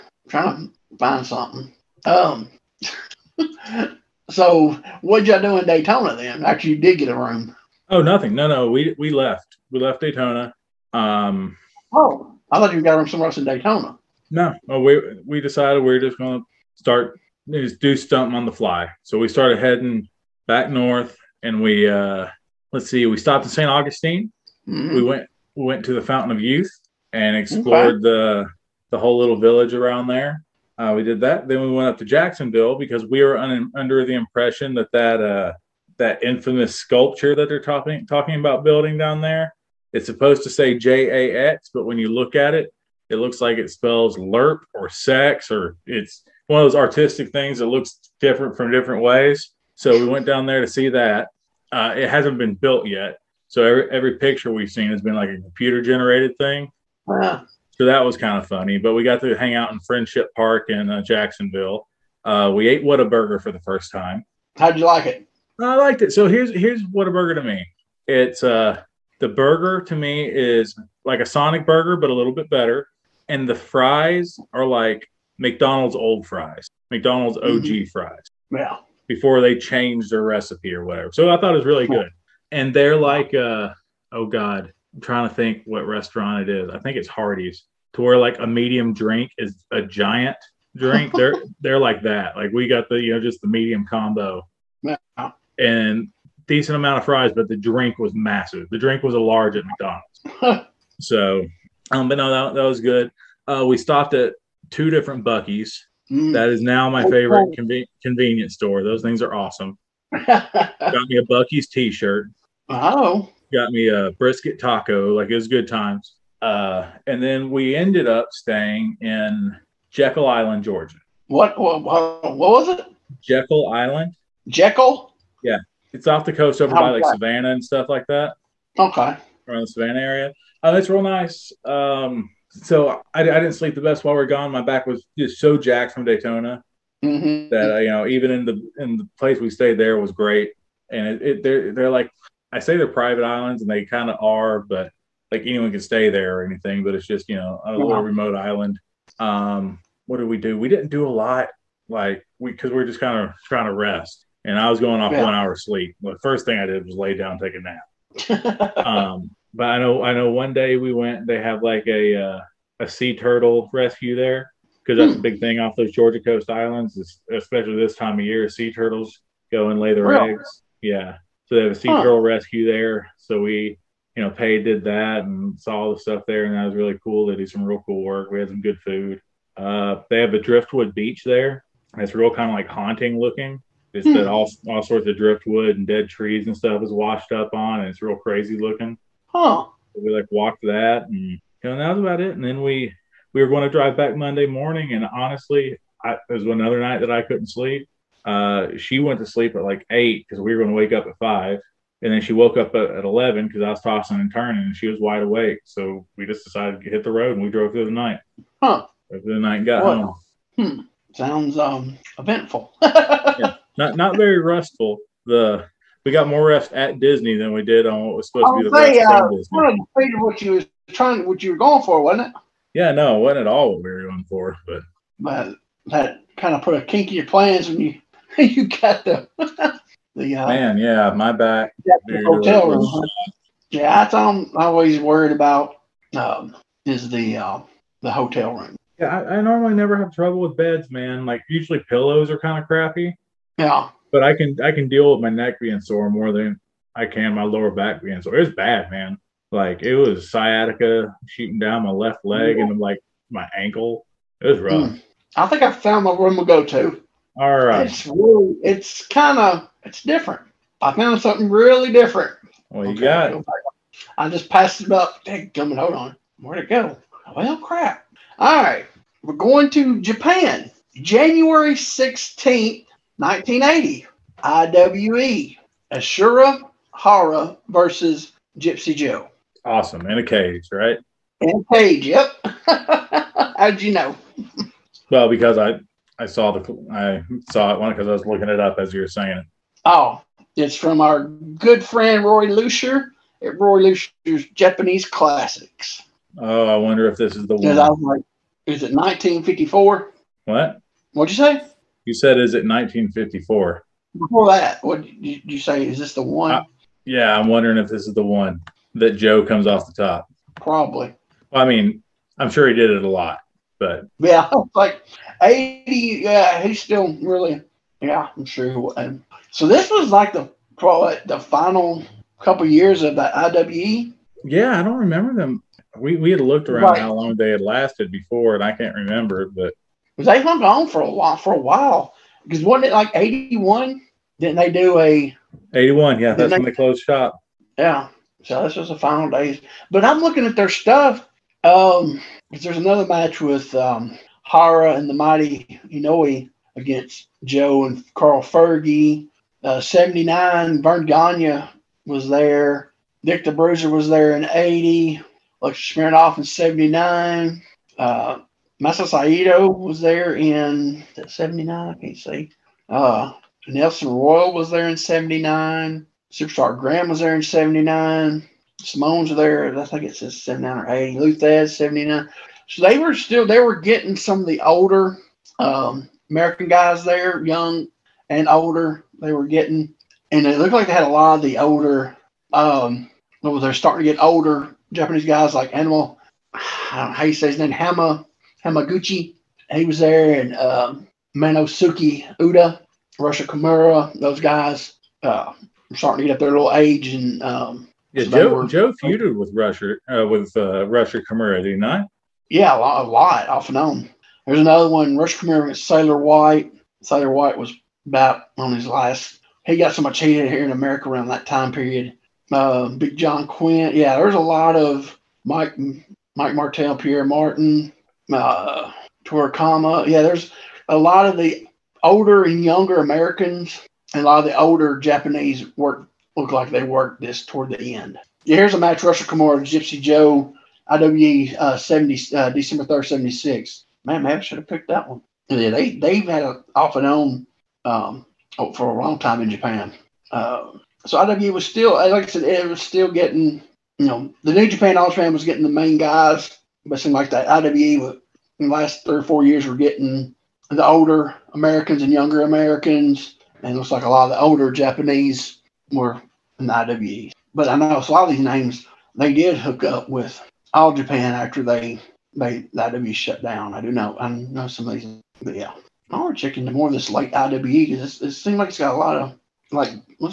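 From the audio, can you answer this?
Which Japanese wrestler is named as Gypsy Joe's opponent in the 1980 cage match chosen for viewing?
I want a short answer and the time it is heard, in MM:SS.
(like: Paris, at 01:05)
Ashura Hara, at 04:35.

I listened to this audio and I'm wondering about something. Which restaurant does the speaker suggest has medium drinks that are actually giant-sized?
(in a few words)
Hardee's.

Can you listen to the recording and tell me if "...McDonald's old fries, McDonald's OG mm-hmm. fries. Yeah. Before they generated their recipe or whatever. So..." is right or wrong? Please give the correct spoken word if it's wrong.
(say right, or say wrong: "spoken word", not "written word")
wrong: "changed", not "generated".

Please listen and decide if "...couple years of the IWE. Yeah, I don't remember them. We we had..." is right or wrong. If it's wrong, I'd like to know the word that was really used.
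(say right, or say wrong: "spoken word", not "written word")
right.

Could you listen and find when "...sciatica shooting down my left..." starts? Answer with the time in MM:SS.
04:10.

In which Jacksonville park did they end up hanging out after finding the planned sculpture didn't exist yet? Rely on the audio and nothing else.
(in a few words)
Friendship Park.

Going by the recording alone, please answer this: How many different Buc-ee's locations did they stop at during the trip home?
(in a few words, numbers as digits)
2.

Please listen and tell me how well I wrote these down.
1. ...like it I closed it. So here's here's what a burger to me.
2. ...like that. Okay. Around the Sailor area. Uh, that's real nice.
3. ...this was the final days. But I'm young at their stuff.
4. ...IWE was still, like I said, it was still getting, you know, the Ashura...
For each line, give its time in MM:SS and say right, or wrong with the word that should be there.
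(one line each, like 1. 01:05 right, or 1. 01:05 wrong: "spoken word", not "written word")
1. 01:04 wrong: "liked", not "closed"
2. 02:07 wrong: "Savannah", not "Sailor"
3. 05:38 wrong: "looking", not "young"
4. 07:21 wrong: "New", not "Ashura".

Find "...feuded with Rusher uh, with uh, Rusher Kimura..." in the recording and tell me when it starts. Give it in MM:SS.
06:39.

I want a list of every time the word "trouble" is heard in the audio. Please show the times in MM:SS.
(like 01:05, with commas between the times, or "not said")
04:00.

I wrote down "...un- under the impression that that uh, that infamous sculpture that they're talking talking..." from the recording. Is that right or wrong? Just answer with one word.
right.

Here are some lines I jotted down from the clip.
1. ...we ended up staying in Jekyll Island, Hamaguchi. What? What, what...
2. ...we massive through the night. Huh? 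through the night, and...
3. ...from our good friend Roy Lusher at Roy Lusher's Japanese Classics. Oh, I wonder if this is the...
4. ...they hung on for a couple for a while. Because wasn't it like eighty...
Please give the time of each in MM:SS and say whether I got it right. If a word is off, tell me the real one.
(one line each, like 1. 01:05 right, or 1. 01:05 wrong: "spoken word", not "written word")
1. 01:57 wrong: "Georgia", not "Hamaguchi"
2. 03:27 wrong: "drove", not "massive"
3. 04:50 right
4. 05:30 wrong: "while", not "couple".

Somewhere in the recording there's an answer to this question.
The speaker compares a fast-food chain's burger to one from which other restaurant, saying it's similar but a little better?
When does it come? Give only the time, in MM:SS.
01:11.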